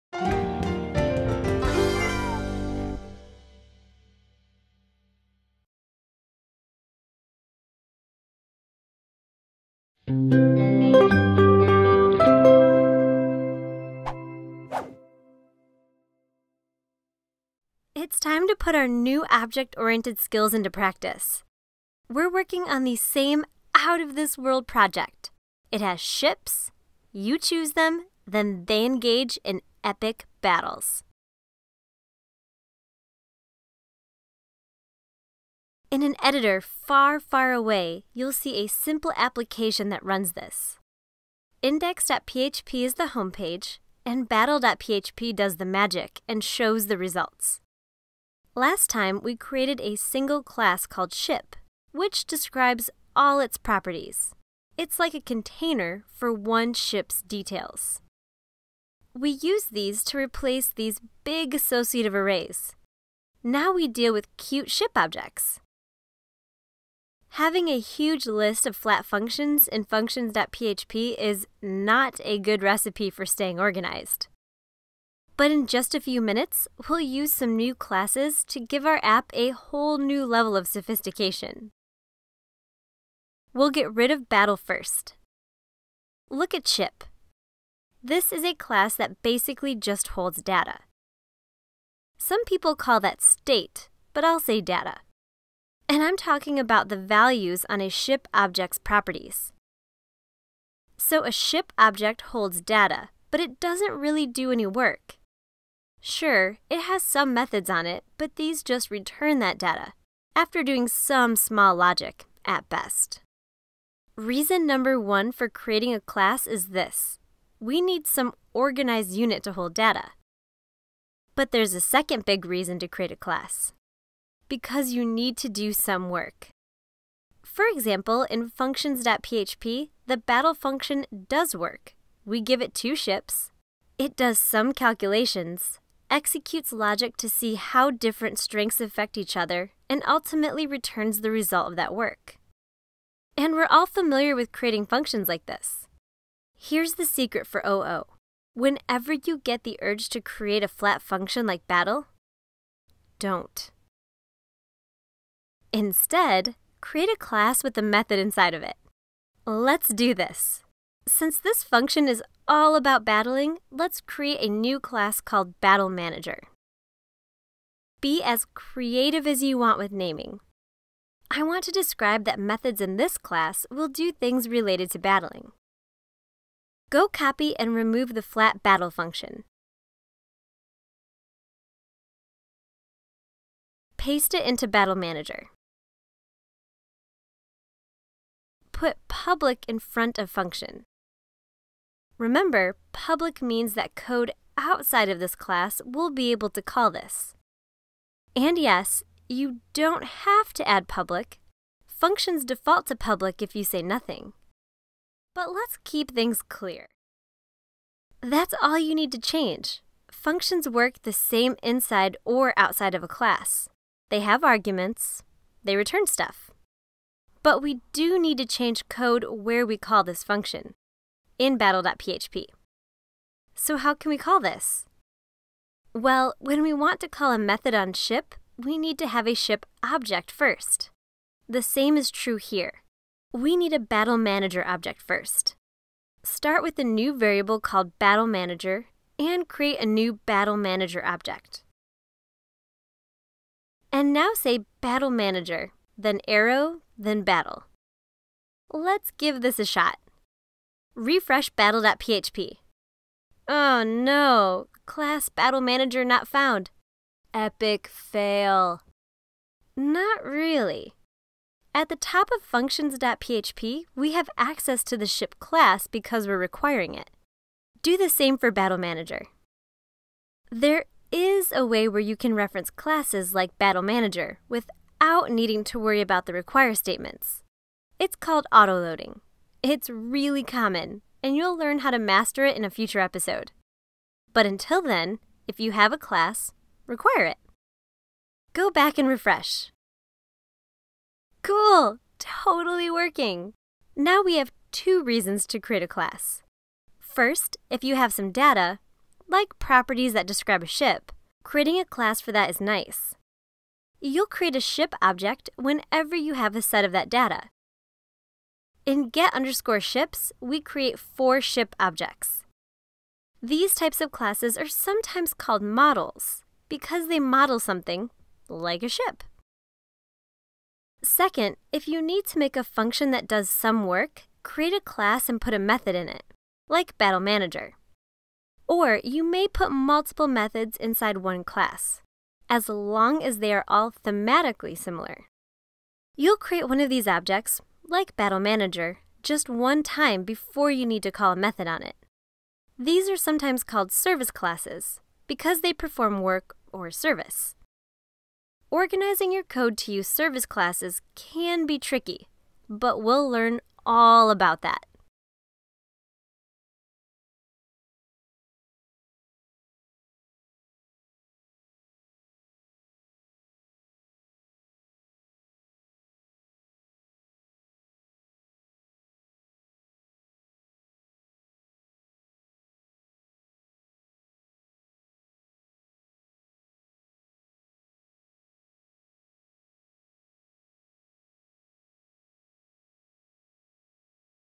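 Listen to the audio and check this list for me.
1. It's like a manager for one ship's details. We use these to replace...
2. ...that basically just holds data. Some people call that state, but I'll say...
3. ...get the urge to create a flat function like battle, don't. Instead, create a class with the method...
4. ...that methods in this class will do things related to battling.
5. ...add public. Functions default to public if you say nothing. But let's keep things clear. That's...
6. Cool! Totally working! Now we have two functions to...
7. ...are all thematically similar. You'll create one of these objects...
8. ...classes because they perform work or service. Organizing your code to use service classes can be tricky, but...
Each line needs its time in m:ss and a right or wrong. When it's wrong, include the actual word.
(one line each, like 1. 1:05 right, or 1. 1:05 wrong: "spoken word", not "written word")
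1. 0:54 wrong: "container", not "manager"
2. 1:28 right
3. 2:29 right
4. 2:52 right
5. 3:20 right
6. 4:51 wrong: "reasons", not "functions"
7. 5:33 right
8. 5:44 right.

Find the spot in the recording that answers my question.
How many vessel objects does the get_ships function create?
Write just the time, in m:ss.
5:10.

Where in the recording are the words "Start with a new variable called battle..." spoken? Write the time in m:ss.
3:56.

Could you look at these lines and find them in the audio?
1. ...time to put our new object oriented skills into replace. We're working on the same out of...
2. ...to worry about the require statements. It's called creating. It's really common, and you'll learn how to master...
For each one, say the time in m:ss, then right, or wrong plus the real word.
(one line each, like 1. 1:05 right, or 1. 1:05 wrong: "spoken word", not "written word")
1. 0:18 wrong: "practice", not "replace"
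2. 4:35 wrong: "autoloading", not "creating".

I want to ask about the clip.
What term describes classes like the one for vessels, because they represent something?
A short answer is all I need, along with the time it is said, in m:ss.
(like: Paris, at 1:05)
Models, at 5:15.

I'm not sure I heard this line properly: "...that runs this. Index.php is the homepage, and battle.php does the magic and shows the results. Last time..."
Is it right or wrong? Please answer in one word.
right.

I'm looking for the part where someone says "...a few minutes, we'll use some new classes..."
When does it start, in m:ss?
1:15.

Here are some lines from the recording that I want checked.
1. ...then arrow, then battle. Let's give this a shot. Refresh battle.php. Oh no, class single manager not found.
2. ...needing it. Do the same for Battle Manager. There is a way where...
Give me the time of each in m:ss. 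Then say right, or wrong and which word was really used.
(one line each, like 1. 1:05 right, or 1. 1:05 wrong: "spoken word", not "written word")
1. 4:06 wrong: "battle", not "single"
2. 4:26 wrong: "requiring", not "needing".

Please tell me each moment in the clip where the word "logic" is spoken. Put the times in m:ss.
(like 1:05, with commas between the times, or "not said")
1:51, 2:16.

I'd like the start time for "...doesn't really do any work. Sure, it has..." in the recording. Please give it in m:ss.
1:43.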